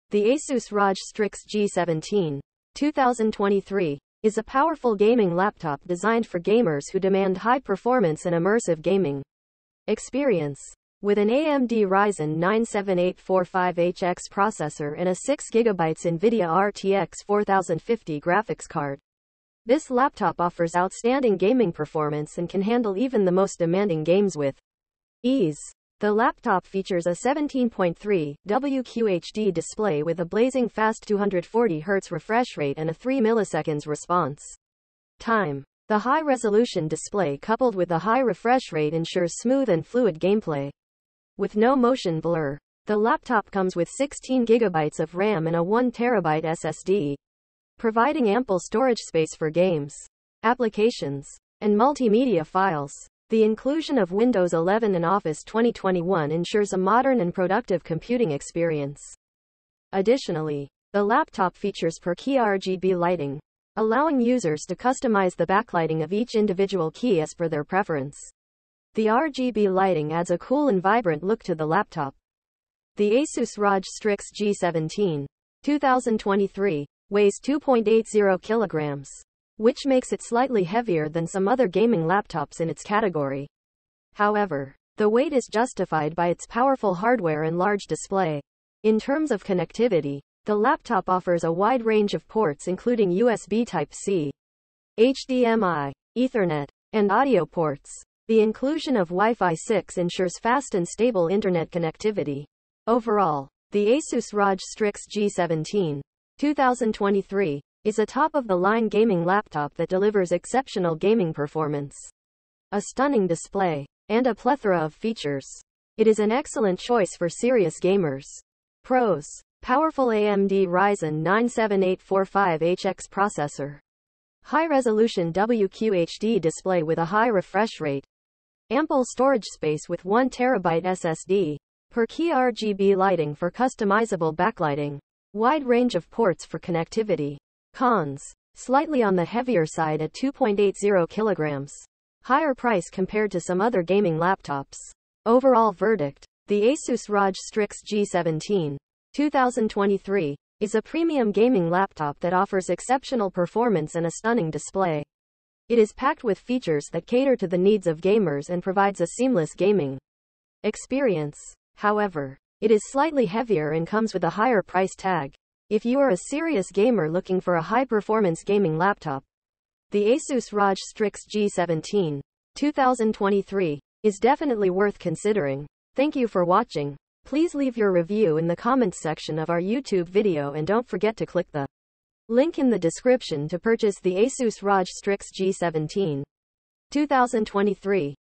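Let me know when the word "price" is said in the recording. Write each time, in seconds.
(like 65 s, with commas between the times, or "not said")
142 s, 164 s.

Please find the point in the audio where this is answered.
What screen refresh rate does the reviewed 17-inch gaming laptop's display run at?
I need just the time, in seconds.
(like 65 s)
31 s.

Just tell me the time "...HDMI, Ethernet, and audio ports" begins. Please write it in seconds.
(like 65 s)
94 s.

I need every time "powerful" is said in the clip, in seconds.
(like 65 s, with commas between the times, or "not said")
4 s, 86 s, 119 s.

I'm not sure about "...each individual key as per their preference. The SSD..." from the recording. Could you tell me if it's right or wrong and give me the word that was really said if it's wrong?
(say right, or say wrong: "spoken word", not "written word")
wrong: "RGB", not "SSD".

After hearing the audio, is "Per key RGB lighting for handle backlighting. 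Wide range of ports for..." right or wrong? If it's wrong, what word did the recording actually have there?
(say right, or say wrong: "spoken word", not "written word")
wrong: "customizable", not "handle".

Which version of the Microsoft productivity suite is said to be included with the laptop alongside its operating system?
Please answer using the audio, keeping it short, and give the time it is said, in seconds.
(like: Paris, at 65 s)
Office 2021, at 55 s.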